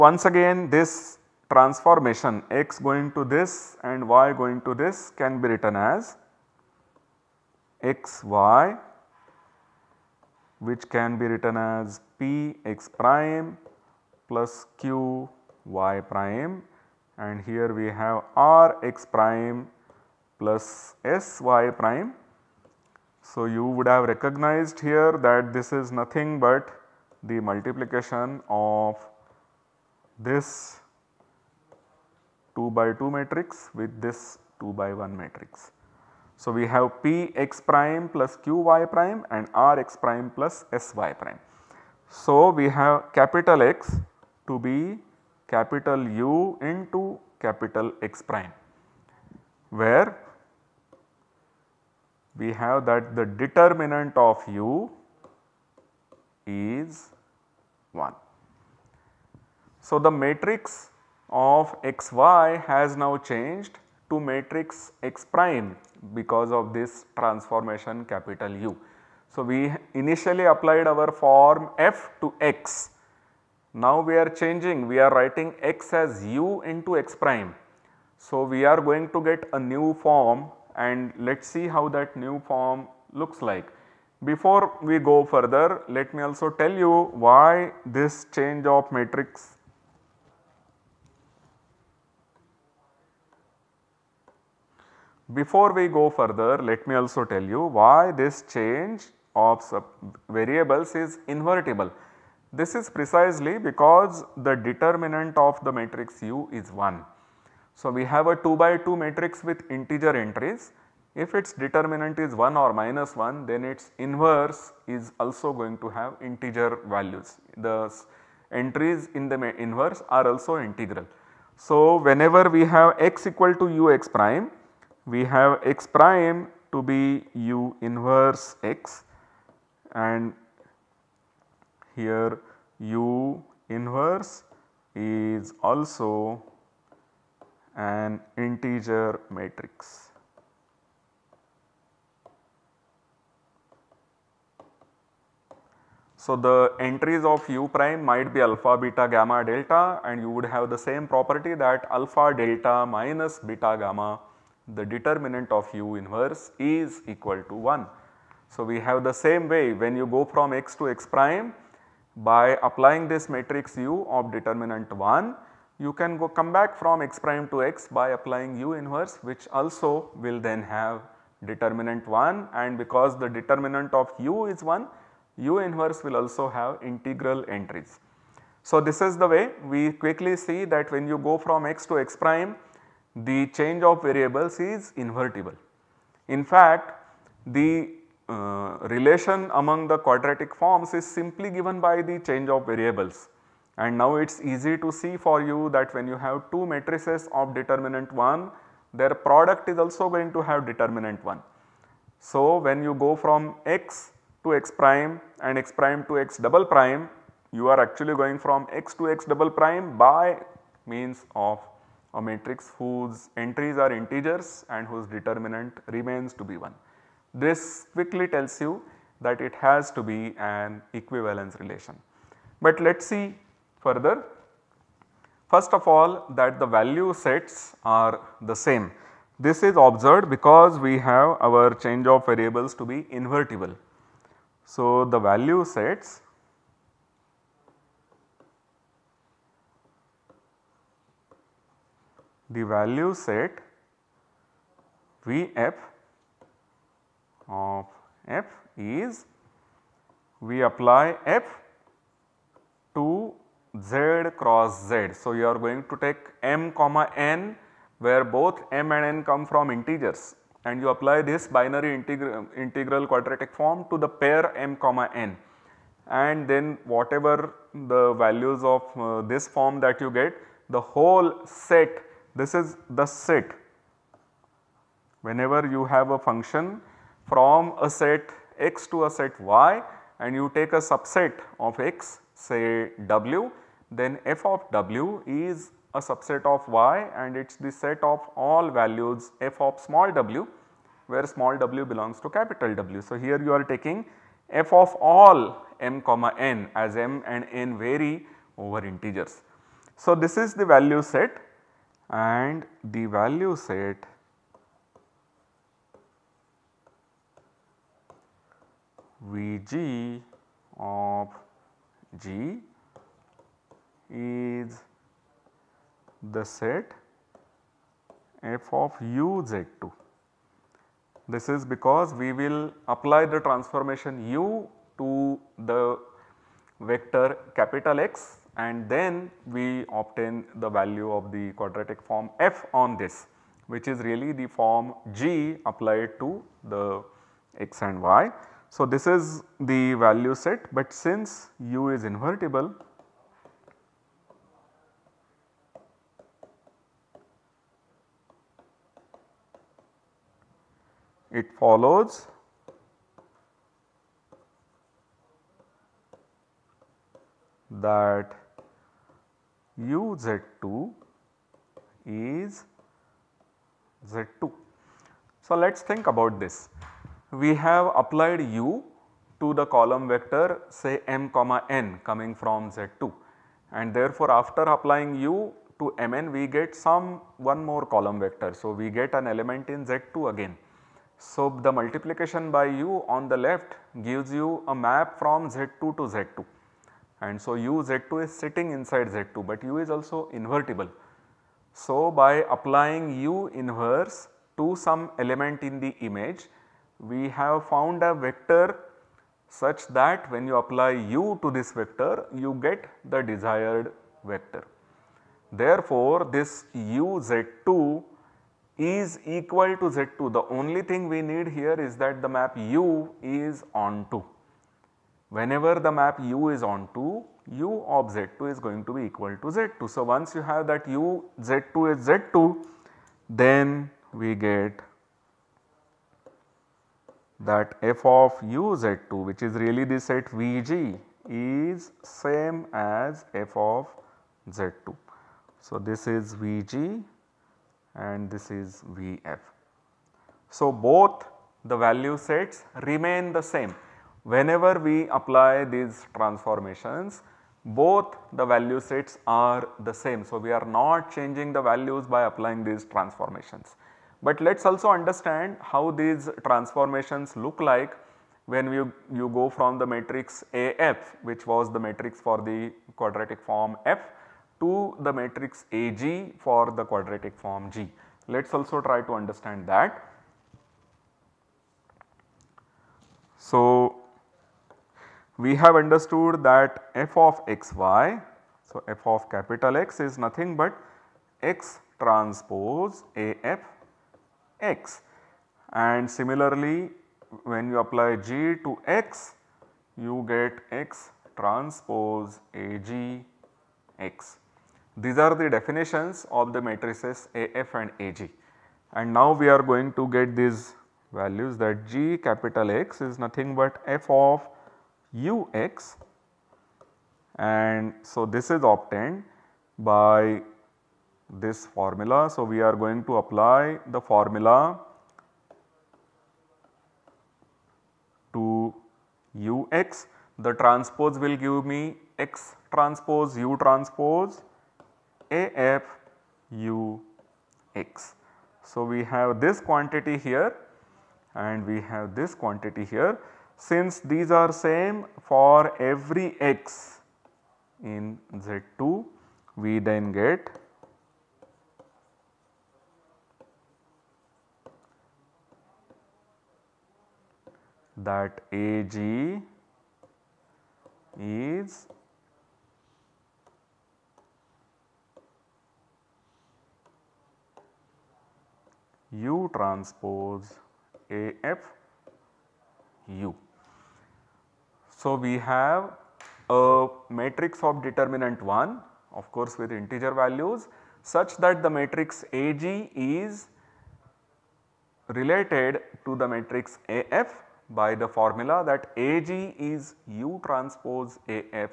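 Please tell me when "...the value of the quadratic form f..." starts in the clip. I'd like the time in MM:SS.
05:30.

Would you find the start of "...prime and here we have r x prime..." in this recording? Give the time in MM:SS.
00:15.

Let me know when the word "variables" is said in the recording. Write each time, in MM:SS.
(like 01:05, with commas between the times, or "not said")
01:40, 03:04, 03:12, 03:52.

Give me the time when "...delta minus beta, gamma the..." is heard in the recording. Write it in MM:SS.
02:32.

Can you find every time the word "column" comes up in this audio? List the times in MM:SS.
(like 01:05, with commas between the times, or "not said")
06:09, 06:17.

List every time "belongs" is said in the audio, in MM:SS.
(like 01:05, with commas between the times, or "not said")
04:51.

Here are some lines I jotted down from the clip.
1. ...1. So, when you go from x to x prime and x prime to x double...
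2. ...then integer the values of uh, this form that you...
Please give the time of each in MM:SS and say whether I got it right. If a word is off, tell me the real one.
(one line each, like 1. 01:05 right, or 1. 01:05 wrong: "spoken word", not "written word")
1. 03:21 right
2. 04:26 wrong: "whatever", not "integer".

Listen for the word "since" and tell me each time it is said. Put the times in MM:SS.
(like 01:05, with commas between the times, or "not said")
05:40, 08:53.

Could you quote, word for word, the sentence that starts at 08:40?
The transpose will give me X transpose U transpose AFUX.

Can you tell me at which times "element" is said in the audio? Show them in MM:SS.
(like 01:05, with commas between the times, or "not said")
06:19, 06:35.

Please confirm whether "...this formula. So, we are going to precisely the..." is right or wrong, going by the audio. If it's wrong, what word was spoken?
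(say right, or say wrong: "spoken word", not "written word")
wrong: "apply", not "precisely".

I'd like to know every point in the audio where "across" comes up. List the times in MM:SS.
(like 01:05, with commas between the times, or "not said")
not said.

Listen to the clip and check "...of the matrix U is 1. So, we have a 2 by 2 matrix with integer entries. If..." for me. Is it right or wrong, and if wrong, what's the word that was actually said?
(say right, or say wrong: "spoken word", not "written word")
right.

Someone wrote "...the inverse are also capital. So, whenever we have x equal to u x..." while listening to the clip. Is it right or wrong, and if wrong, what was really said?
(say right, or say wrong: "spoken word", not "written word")
wrong: "integral", not "capital".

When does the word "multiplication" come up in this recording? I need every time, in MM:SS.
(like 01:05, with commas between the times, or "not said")
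00:27, 06:21.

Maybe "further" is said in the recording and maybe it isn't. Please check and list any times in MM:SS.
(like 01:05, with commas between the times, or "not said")
01:25, 01:36, 03:43.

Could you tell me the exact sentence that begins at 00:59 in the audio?
So, the matrix of x y has now changed to matrix x prime because of this transformation capital U.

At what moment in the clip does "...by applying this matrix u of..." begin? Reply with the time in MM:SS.
02:42.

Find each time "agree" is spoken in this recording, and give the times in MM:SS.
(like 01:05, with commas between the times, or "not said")
not said.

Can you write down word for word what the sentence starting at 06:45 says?
Therefore, this u Z2 is equal to Z2.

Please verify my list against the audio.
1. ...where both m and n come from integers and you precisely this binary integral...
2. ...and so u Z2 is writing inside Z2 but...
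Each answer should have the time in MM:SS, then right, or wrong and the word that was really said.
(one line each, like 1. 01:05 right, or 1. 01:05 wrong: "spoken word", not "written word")
1. 04:17 wrong: "apply", not "precisely"
2. 06:27 wrong: "sitting", not "writing".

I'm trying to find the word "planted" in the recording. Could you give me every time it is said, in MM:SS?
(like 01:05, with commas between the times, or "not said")
not said.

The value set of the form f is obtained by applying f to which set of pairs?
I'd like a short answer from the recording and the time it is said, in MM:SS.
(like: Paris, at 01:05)
Z cross Z, at 04:13.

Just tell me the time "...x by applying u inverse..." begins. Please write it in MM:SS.
02:47.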